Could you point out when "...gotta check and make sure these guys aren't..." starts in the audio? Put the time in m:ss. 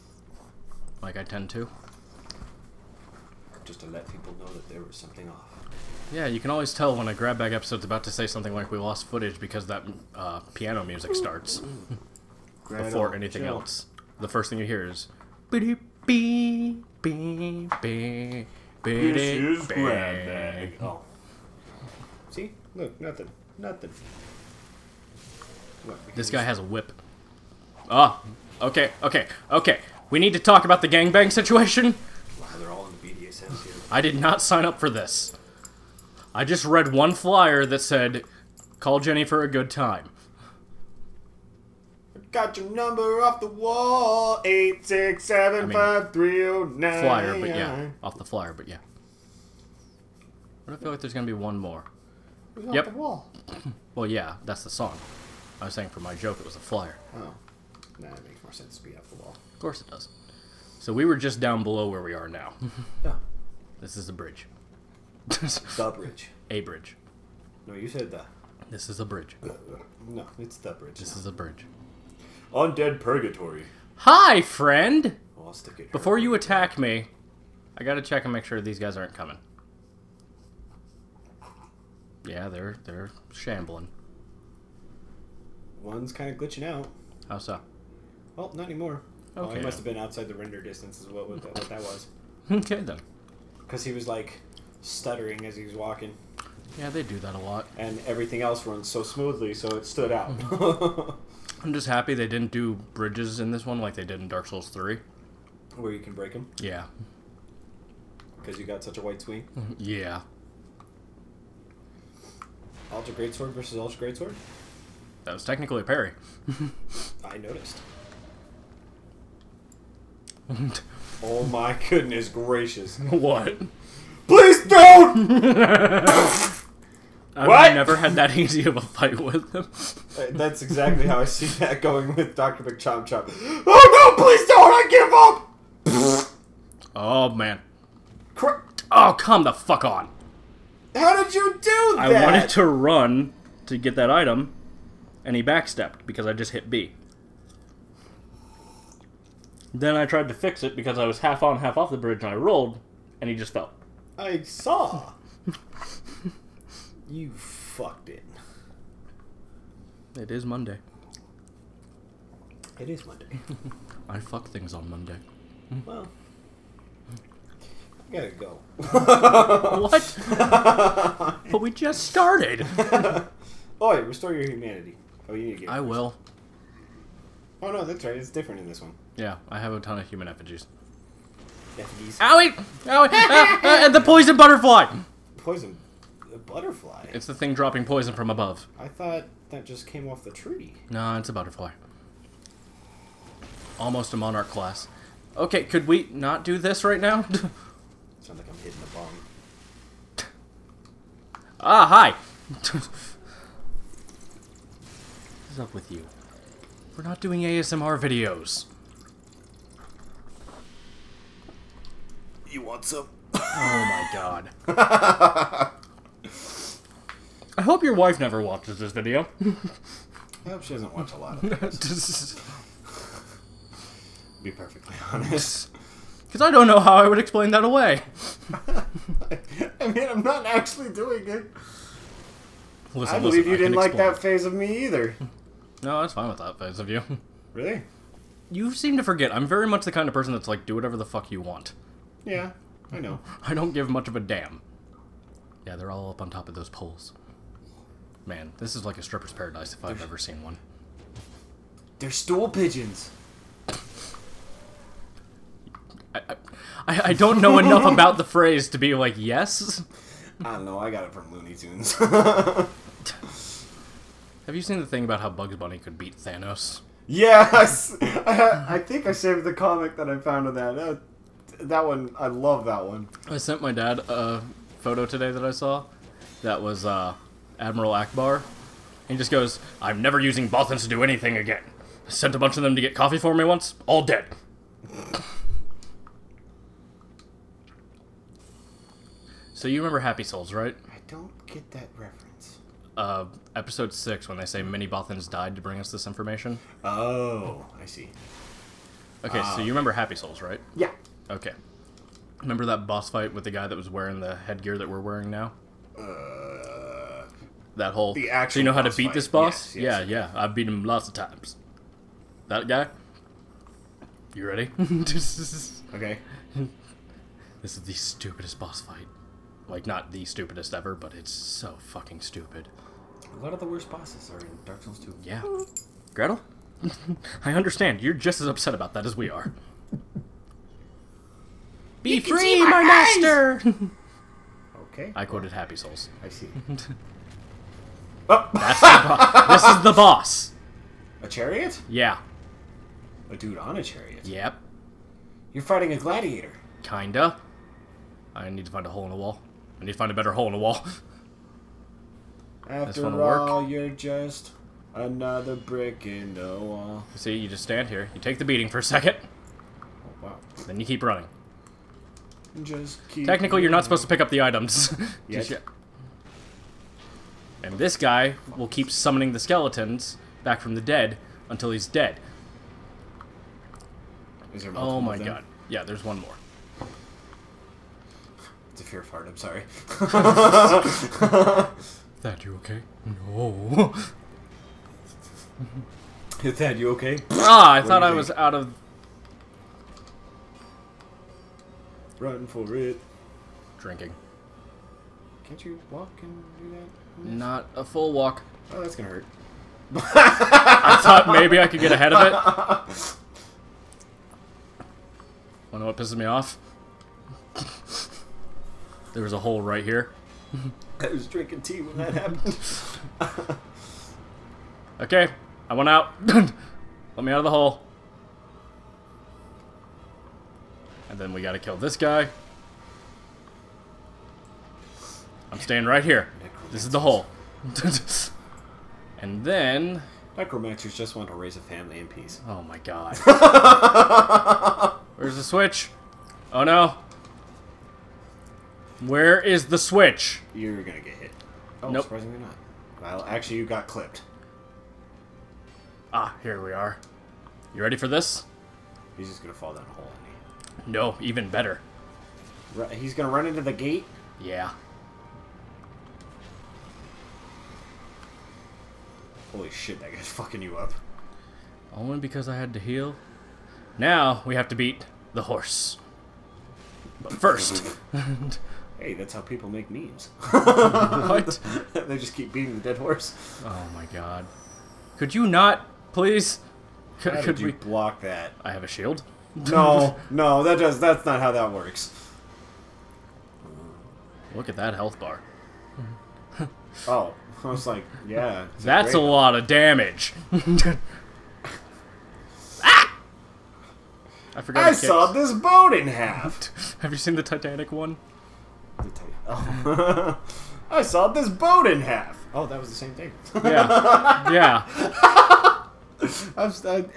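1:17.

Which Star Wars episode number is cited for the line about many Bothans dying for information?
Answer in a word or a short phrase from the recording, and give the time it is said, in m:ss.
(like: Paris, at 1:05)
6, at 4:53.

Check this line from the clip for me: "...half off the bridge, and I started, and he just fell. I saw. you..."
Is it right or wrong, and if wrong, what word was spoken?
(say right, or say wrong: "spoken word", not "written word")
wrong: "rolled", not "started".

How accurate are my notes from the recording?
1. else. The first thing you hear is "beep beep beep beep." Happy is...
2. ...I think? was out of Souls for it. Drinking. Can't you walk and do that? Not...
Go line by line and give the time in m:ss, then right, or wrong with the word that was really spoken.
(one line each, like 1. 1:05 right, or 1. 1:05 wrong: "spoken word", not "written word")
1. 0:13 wrong: "This", not "Happy"
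2. 6:28 wrong: "Run", not "Souls".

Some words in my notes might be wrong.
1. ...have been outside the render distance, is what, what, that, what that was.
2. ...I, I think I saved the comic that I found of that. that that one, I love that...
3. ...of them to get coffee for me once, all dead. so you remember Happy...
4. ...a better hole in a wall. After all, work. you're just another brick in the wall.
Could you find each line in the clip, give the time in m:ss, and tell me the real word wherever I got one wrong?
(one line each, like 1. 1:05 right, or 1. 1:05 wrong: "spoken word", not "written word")
1. 1:29 right
2. 4:28 right
3. 4:42 right
4. 5:50 right.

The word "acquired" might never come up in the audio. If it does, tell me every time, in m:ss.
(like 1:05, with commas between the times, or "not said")
not said.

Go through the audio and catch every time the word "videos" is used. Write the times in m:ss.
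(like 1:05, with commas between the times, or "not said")
3:27, 3:38.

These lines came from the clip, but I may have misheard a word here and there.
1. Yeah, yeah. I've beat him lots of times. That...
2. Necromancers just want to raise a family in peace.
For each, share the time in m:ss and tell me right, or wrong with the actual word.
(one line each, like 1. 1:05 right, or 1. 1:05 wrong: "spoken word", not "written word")
1. 5:10 right
2. 7:10 right.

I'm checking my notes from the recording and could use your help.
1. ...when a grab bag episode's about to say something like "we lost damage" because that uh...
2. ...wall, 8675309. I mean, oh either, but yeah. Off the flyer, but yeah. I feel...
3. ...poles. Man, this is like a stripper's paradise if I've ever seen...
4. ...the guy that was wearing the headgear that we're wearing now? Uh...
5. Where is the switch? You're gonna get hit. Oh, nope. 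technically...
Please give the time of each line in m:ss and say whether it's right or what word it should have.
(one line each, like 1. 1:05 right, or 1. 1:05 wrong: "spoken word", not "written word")
1. 0:06 wrong: "footage", not "damage"
2. 0:43 wrong: "flyer", not "either"
3. 4:06 right
4. 5:03 right
5. 7:19 wrong: "surprisingly", not "technically".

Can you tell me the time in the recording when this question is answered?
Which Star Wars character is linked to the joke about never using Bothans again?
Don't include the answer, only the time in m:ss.
4:37.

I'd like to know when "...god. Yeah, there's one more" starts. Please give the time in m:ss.
6:15.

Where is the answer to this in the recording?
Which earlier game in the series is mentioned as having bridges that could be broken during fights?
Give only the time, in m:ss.
1:44.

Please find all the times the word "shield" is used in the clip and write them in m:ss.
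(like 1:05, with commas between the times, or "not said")
7:58.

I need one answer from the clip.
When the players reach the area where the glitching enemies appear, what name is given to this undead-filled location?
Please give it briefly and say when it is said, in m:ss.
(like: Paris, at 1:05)
Undead Purgatory, at 1:12.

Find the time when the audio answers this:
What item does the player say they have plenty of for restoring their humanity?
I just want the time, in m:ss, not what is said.
3:00.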